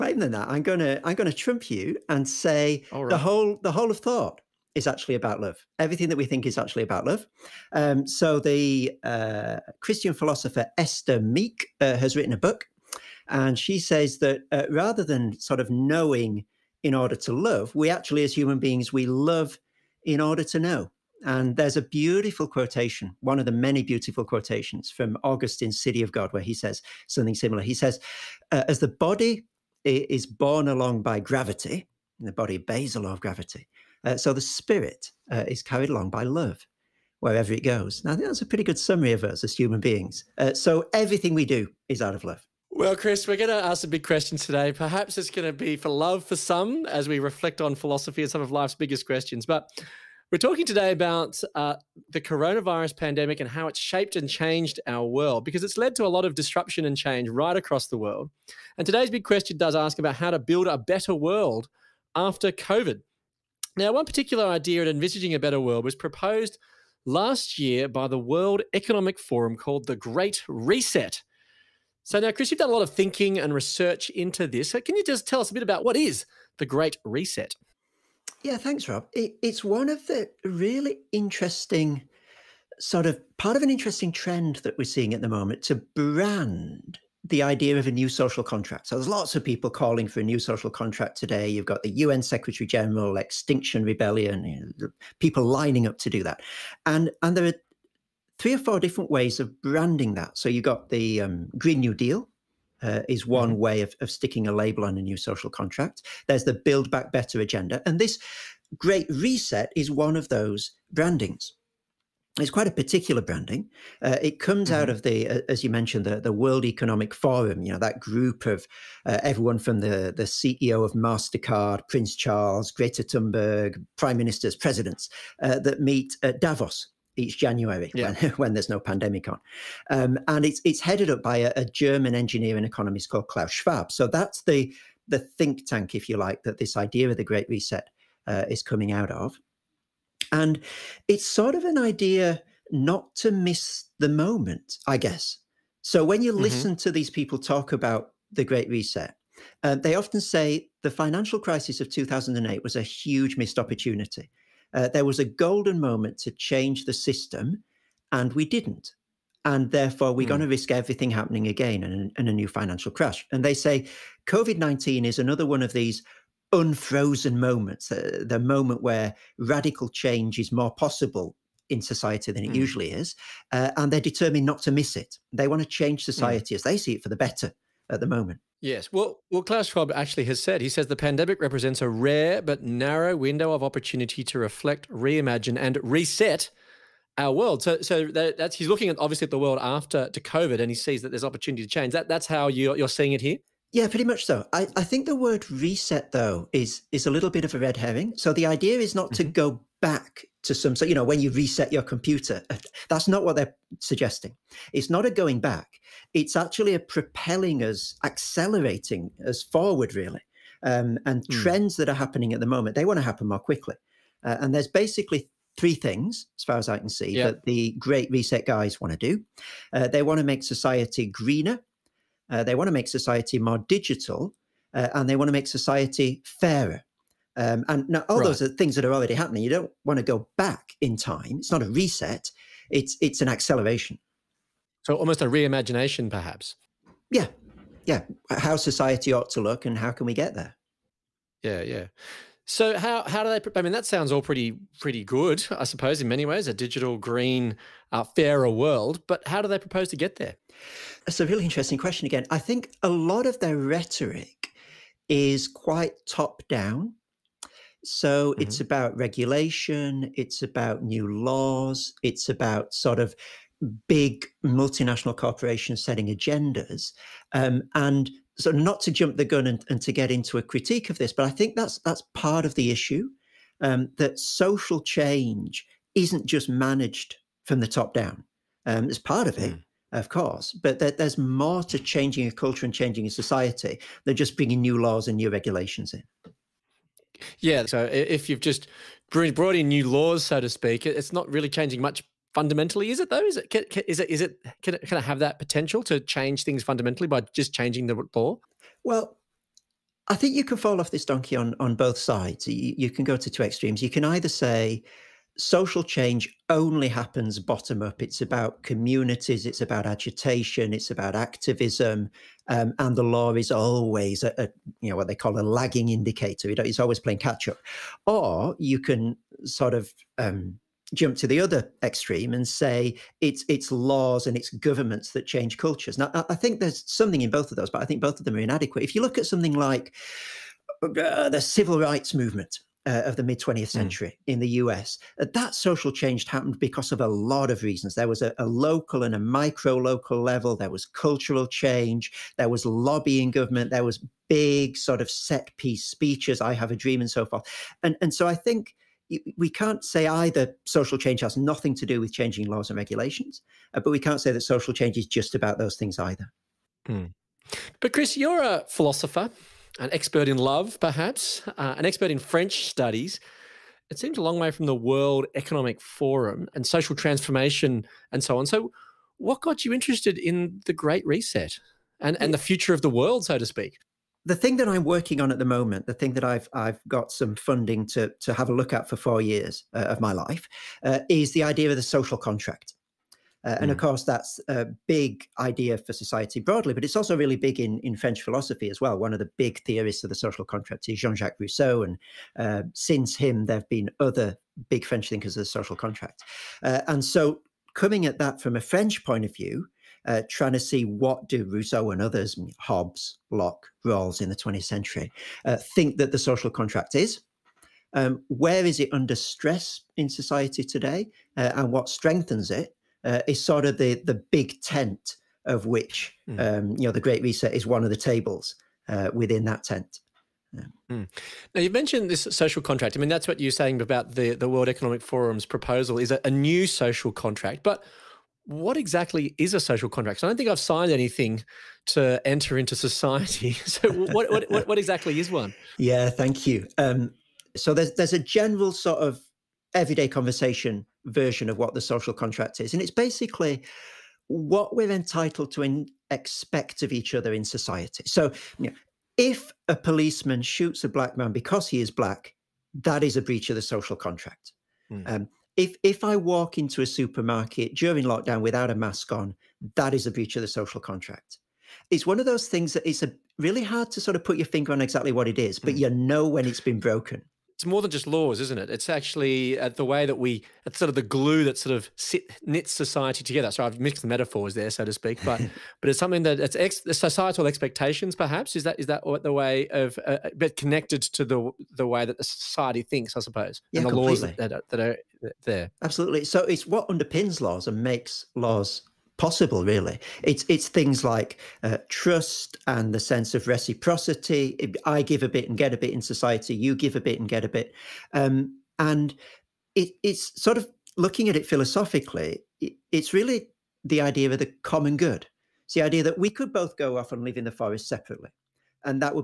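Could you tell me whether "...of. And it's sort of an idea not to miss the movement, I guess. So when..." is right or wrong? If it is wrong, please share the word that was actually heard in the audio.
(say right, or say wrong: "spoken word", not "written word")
wrong: "moment", not "movement".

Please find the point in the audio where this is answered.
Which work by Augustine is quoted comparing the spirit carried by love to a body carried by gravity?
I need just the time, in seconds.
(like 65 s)
25 s.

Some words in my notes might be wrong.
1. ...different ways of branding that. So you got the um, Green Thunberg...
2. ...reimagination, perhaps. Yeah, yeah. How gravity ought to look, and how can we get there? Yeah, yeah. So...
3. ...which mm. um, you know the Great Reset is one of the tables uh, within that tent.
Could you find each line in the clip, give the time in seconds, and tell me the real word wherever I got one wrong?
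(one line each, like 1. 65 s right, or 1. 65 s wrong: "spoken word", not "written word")
1. 98 s wrong: "New", not "Thunberg"
2. 235 s wrong: "society", not "gravity"
3. 415 s right.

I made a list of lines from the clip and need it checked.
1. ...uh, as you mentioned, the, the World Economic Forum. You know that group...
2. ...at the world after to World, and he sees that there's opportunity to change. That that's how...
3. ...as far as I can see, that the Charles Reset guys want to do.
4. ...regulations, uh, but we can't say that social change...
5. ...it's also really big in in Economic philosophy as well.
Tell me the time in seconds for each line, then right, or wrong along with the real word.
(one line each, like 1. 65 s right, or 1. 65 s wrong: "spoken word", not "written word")
1. 115 s right
2. 189 s wrong: "COVID", not "World"
3. 216 s wrong: "Great", not "Charles"
4. 352 s right
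5. 386 s wrong: "French", not "Economic".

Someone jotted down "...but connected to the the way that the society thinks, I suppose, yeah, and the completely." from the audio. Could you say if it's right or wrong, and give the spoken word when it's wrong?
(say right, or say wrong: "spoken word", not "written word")
right.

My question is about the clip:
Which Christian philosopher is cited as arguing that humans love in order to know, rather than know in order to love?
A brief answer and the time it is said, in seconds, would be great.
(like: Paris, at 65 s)
Esther Meek, at 10 s.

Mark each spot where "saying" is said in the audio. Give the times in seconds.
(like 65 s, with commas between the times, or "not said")
423 s.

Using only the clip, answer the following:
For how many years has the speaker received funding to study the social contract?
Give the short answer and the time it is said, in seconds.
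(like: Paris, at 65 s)
4, at 378 s.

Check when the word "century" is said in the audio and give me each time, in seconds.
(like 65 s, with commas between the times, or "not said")
333 s, 404 s.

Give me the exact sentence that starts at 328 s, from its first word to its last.
If you look at something like uh, the civil rights movement, uh, of the mid 20th hmm.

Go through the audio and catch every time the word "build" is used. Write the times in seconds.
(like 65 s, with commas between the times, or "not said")
60 s, 106 s.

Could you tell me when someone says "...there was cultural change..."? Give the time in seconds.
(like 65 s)
340 s.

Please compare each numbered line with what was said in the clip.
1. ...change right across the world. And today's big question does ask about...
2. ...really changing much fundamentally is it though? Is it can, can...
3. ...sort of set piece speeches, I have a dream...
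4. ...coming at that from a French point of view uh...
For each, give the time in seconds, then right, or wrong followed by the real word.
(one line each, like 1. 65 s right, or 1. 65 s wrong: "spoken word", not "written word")
1. 56 s right
2. 291 s right
3. 344 s right
4. 397 s right.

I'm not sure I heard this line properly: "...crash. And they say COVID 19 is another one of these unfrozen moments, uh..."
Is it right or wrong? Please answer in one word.
right.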